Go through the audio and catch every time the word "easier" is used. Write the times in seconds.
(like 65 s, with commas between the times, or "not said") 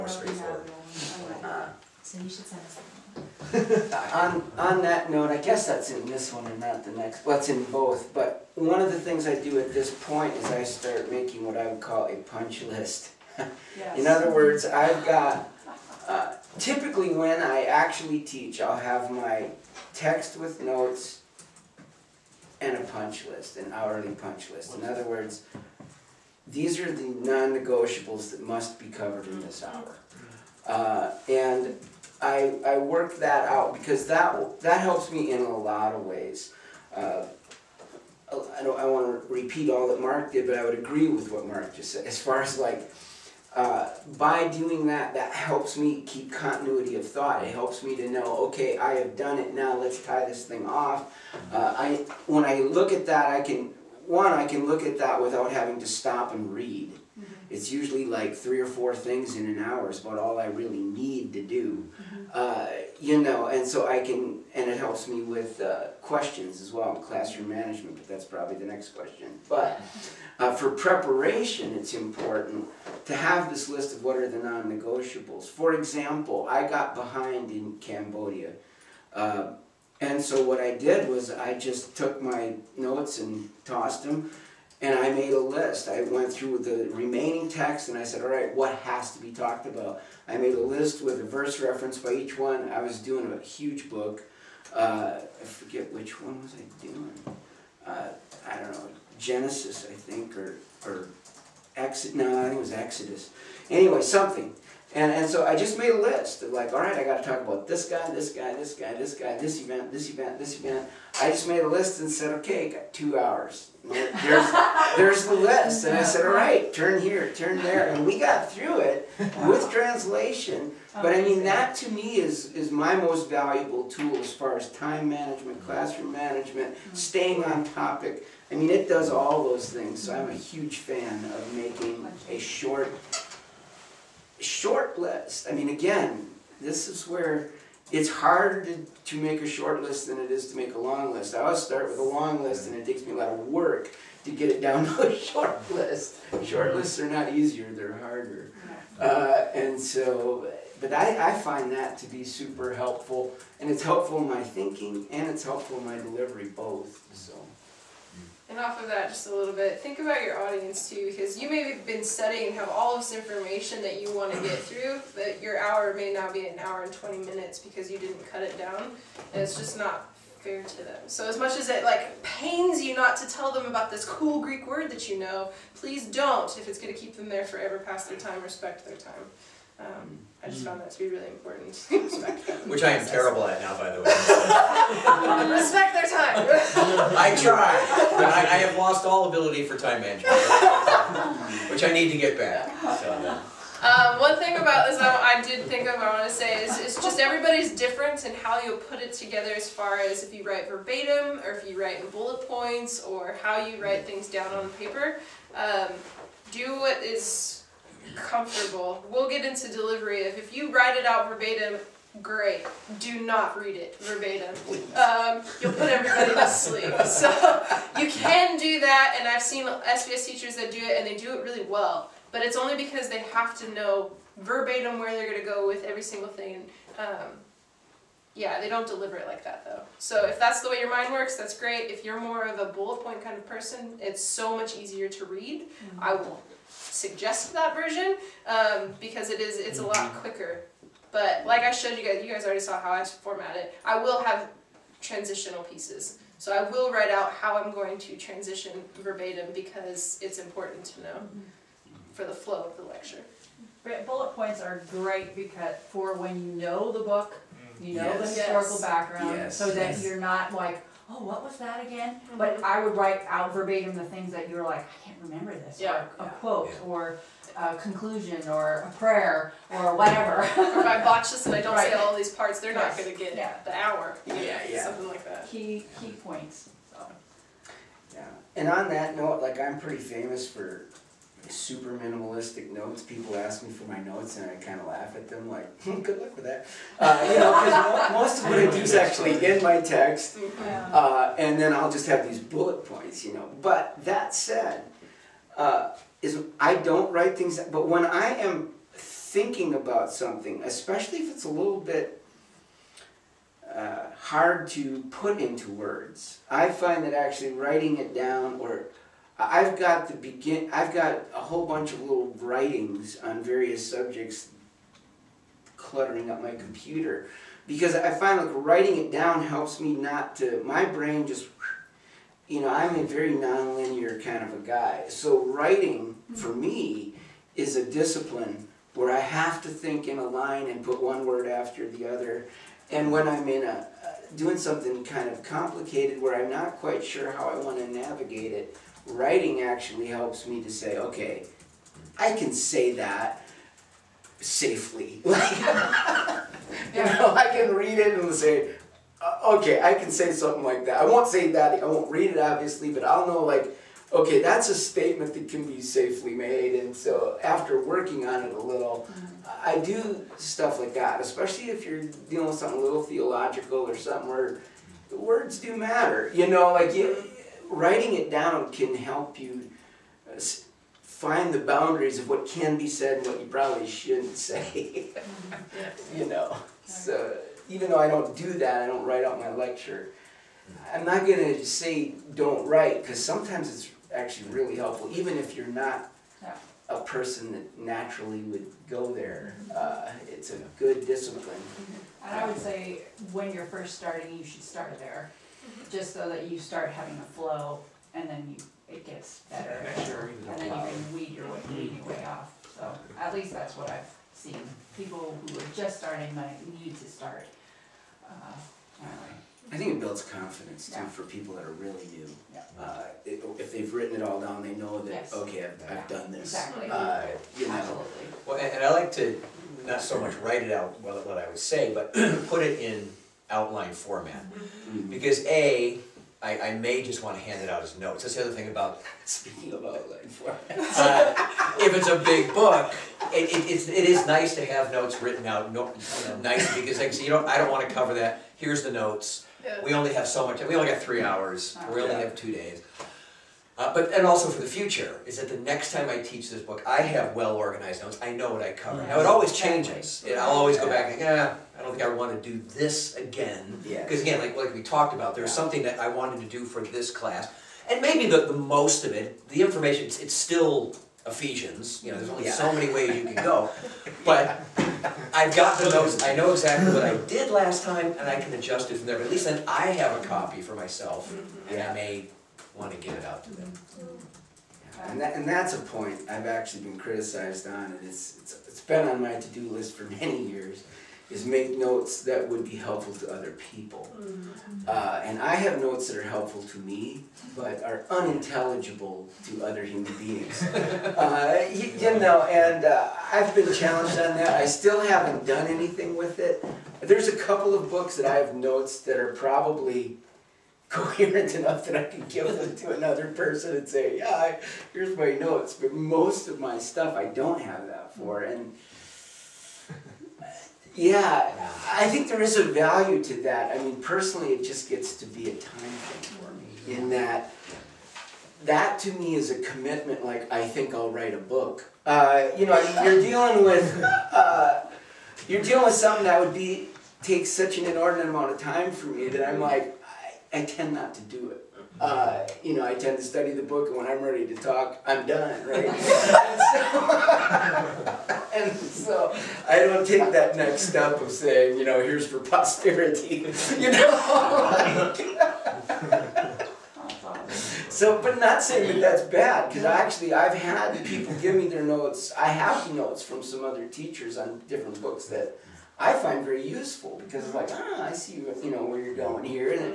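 147 s, 234 s.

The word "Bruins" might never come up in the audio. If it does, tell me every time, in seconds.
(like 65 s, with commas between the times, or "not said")
not said.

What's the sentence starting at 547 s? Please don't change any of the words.
so, but not saying that that's bad, because actually I've had people give me their notes.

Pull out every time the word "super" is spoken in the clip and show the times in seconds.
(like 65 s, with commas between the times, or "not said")
152 s, 281 s.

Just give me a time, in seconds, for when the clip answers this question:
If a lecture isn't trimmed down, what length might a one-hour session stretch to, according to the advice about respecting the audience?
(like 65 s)
166 s.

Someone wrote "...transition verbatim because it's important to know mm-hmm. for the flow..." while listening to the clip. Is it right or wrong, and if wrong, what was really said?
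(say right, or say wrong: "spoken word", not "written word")
right.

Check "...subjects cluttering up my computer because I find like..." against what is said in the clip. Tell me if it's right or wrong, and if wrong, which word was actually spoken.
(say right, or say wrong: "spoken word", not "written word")
right.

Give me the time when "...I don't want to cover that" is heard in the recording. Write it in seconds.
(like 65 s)
437 s.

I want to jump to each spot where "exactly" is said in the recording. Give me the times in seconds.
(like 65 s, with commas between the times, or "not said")
416 s, 466 s.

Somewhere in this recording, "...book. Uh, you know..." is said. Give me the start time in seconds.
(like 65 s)
521 s.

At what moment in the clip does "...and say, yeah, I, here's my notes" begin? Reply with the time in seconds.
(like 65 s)
503 s.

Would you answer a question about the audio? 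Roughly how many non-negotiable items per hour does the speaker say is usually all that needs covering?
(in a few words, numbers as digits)
3 or 4.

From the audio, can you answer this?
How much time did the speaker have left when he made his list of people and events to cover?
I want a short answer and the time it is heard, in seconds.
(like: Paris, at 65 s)
2 hours, at 112 s.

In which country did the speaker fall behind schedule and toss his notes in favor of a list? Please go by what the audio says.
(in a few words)
Cambodia.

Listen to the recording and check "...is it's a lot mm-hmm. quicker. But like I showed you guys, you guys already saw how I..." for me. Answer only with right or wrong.
right.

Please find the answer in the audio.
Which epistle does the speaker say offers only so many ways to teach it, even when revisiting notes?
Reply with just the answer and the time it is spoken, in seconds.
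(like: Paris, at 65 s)
Ephesians, at 461 s.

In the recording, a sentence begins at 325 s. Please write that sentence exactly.
So writing for me is a discipline where I have to think in a line and put one word after the other.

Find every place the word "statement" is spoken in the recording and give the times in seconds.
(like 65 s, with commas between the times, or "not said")
354 s.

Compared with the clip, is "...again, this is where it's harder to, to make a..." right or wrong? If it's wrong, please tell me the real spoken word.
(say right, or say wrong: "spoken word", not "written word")
right.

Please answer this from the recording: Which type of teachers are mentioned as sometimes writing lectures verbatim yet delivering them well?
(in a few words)
SBS teachers.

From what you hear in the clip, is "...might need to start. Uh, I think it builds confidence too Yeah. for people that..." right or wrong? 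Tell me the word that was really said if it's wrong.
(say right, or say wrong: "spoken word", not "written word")
right.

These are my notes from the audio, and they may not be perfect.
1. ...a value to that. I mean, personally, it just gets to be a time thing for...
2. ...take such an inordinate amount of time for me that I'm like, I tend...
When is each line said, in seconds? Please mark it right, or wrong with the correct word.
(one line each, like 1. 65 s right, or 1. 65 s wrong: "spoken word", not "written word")
1. 512 s right
2. 527 s right.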